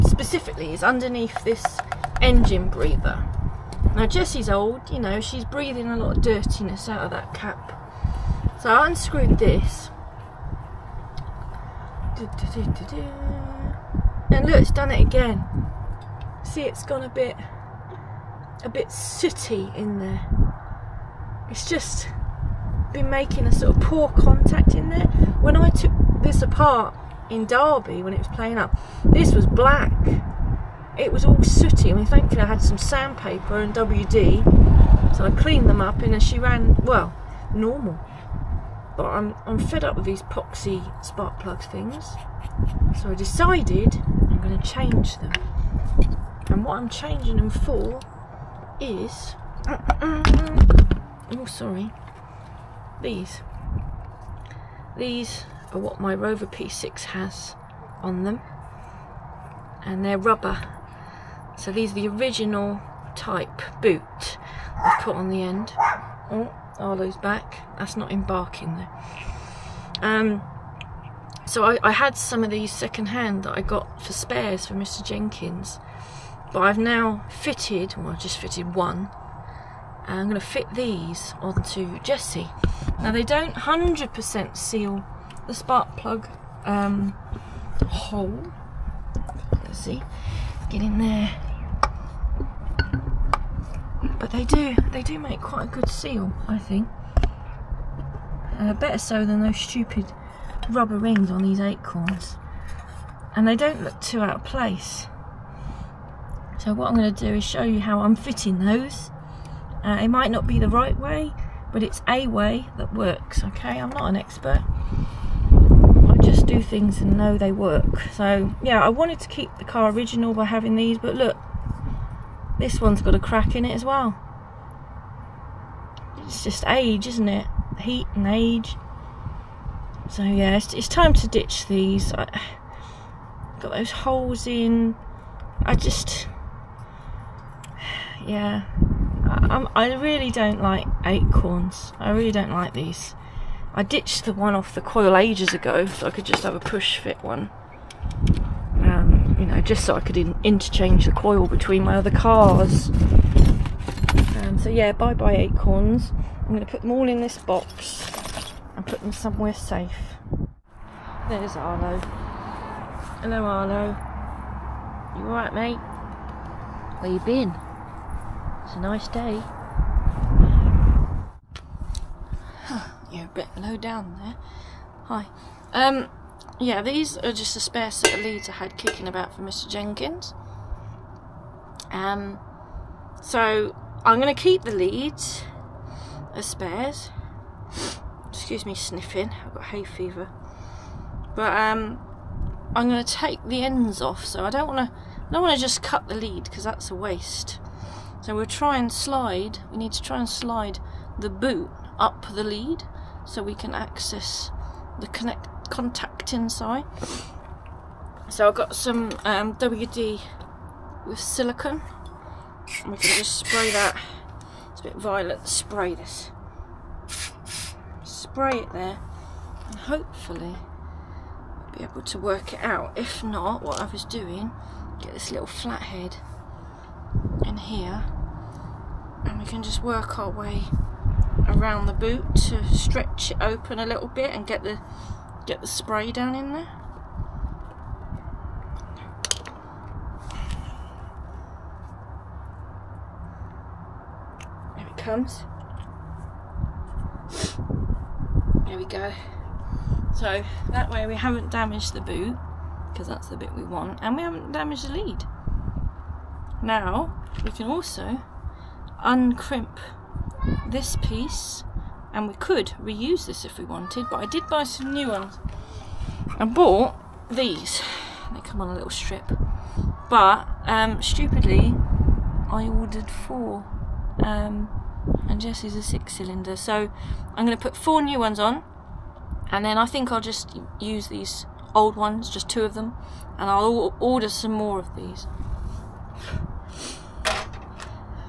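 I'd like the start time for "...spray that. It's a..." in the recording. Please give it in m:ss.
3:33.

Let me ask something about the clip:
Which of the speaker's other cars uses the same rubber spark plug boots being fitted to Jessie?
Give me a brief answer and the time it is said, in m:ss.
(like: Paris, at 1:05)
Rover P6, at 0:56.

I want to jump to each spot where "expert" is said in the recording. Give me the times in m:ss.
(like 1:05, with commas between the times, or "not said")
1:54.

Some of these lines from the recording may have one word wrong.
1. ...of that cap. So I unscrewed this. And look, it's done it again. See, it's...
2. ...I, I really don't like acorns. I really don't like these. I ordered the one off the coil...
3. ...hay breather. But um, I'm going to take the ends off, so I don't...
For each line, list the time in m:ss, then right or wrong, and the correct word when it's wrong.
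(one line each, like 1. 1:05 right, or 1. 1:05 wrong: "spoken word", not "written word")
1. 0:07 right
2. 2:19 wrong: "ditched", not "ordered"
3. 3:09 wrong: "fever", not "breather".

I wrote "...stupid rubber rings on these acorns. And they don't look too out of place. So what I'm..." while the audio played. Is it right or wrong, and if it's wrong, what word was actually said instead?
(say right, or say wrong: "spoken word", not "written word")
right.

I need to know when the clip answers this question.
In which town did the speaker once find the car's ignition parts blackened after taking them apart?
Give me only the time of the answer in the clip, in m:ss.
0:27.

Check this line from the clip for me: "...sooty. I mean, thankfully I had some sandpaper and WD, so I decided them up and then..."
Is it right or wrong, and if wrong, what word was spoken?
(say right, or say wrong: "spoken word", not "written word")
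wrong: "cleaned", not "decided".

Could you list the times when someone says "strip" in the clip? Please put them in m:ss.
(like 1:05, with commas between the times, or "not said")
4:28.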